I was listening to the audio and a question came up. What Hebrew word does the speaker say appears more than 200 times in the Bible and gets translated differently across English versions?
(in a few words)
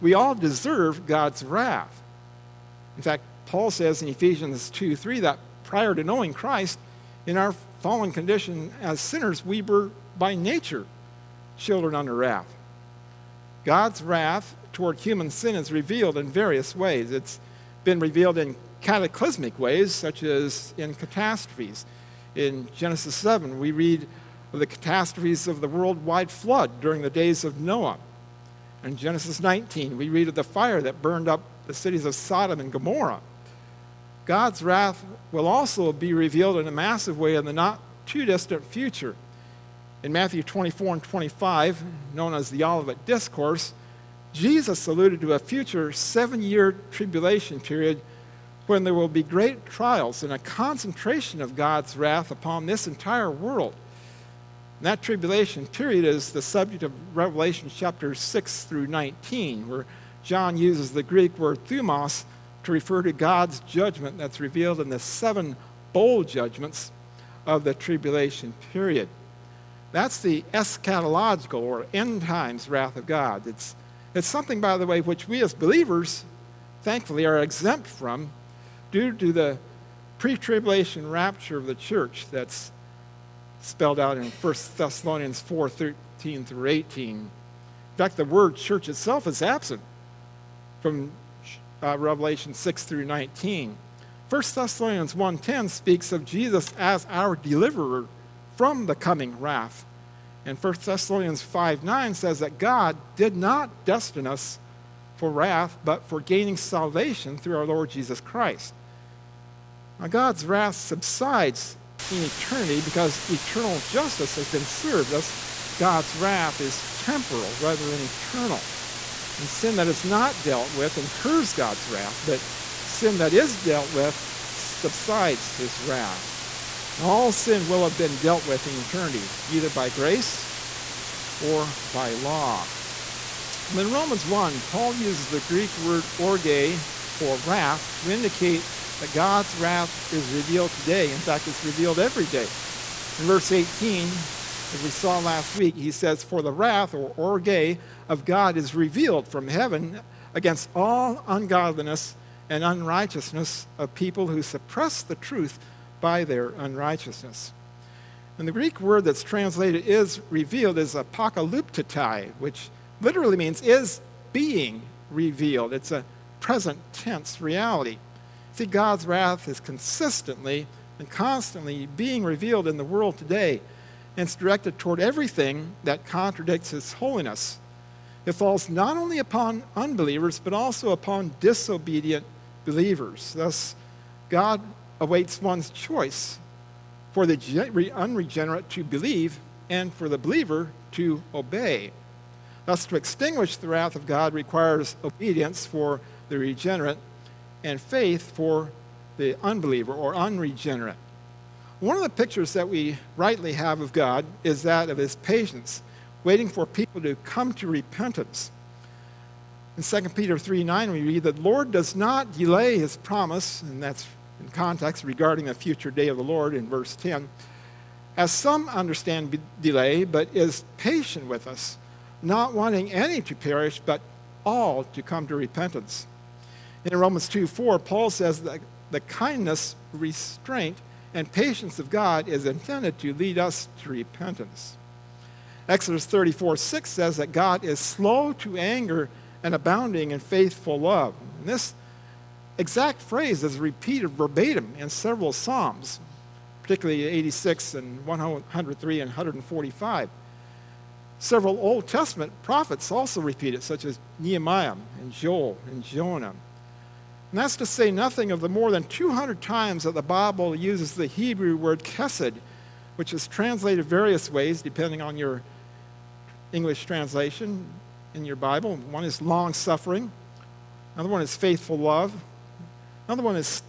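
kesed.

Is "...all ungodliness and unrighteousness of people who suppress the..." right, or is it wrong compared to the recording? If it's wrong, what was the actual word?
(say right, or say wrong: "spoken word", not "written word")
right.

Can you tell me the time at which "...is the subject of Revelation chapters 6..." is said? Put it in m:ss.
0:56.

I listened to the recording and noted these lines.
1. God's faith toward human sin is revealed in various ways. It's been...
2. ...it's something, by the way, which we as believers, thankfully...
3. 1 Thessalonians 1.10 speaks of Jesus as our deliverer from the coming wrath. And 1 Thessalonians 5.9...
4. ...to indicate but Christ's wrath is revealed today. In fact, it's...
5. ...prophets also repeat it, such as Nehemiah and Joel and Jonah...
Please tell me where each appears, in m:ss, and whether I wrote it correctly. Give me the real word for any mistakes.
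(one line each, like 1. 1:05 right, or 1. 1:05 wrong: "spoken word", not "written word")
1. 0:13 wrong: "wrath", not "faith"
2. 1:14 right
3. 1:34 right
4. 2:18 wrong: "God", not "Christ"
5. 4:12 right.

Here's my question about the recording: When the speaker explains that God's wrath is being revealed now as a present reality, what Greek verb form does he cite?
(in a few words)
apokaluptetai.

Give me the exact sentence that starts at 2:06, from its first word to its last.
And all sin will have been dealt with in eternity, either by grace or by law.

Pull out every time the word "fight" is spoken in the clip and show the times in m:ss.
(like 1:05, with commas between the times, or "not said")
not said.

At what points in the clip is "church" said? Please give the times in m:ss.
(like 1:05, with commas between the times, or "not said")
1:21, 1:28.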